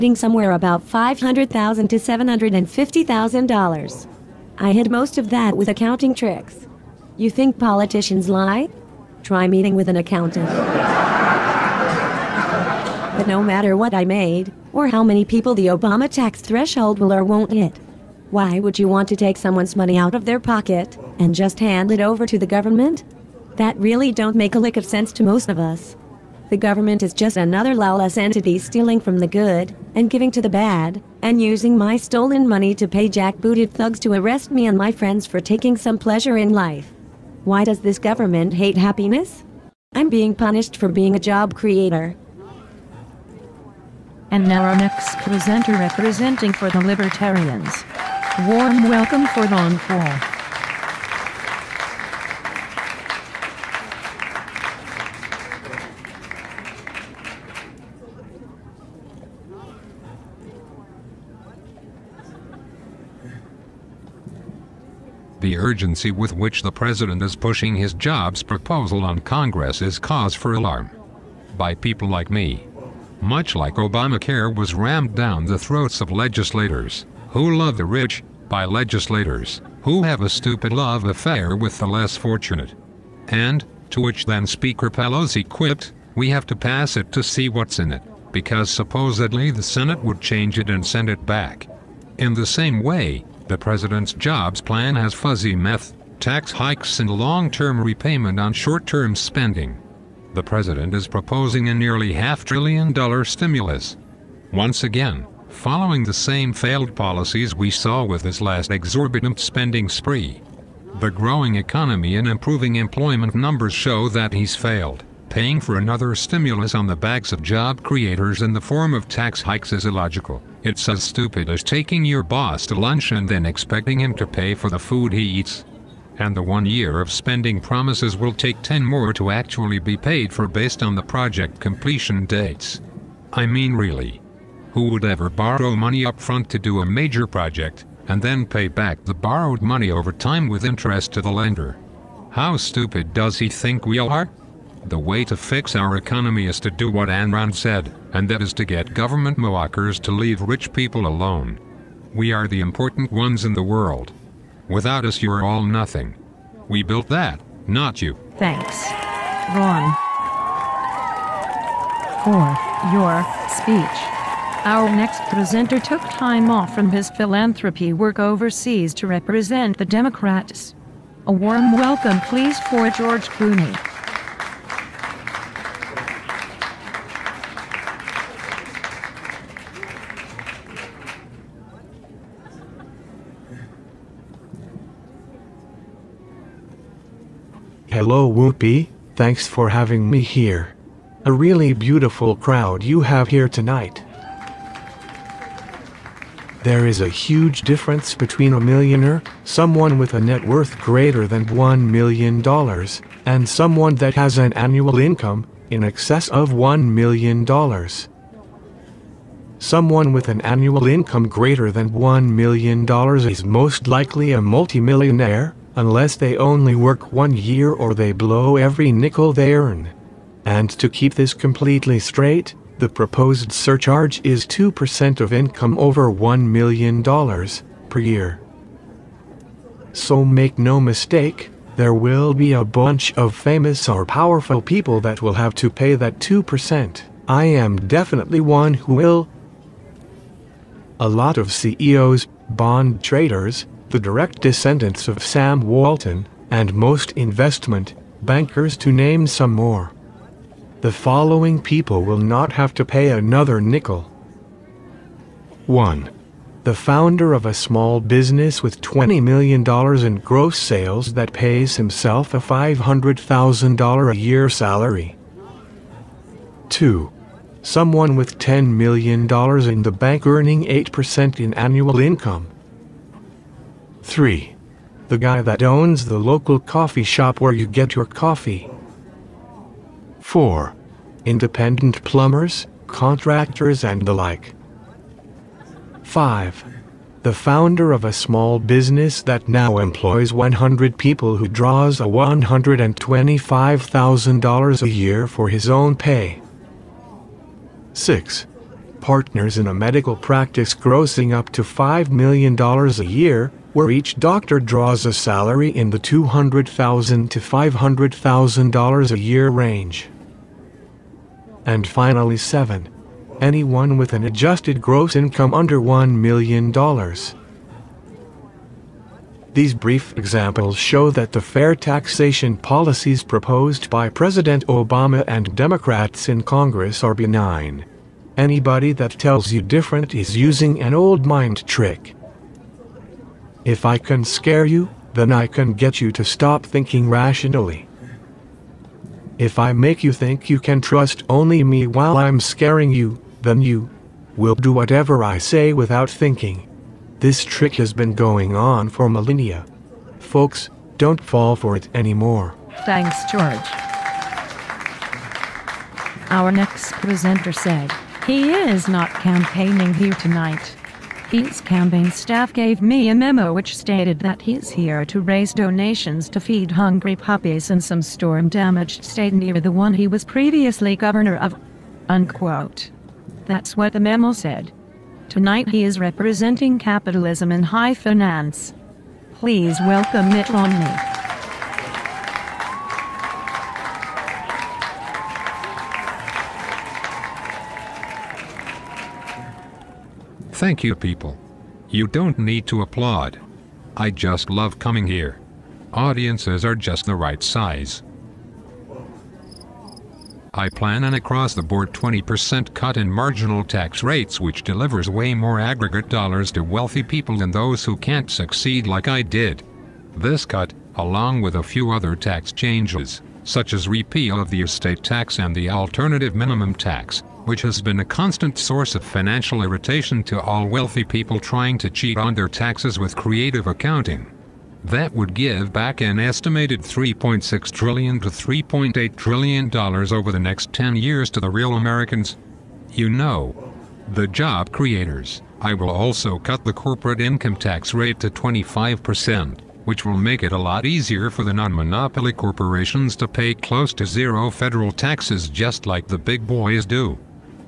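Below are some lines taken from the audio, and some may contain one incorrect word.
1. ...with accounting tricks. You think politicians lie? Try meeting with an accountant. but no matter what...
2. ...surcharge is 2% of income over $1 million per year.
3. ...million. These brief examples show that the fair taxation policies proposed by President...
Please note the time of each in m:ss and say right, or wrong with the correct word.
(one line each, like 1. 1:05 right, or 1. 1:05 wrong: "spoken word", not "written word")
1. 0:05 right
2. 3:43 right
3. 5:16 right.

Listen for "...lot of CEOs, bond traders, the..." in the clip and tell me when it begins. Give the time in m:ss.
4:01.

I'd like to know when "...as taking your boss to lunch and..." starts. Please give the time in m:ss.
2:01.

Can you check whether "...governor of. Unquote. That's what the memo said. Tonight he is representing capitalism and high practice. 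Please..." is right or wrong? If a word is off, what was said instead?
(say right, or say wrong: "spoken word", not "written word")
wrong: "finance", not "practice".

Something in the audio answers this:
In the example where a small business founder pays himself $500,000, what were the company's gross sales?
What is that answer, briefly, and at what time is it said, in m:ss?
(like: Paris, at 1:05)
$20 million, at 4:18.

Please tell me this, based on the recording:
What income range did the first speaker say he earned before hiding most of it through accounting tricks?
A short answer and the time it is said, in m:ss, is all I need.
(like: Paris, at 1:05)
$500,000 to $750,000, at 0:00.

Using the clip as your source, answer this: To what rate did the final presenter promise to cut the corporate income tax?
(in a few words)
25%.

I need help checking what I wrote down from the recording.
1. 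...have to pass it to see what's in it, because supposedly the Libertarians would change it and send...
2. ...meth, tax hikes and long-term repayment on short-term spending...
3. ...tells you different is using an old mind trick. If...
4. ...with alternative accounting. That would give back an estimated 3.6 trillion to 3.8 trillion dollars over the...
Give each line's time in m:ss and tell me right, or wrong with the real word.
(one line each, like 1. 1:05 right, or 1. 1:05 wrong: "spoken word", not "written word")
1. 1:26 wrong: "Senate", not "Libertarians"
2. 1:35 right
3. 5:29 right
4. 7:02 wrong: "creative", not "alternative".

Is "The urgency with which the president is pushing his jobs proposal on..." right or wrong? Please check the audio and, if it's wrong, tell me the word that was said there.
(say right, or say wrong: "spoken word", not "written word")
right.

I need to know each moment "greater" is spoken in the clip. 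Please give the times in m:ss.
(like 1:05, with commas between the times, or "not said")
3:20, 3:31.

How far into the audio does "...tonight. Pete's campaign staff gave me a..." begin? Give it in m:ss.
6:00.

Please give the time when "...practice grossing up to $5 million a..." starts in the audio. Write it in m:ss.
5:00.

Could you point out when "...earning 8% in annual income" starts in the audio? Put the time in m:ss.
4:30.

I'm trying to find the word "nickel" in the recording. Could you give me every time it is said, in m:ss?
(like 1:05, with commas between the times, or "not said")
3:38, 4:13.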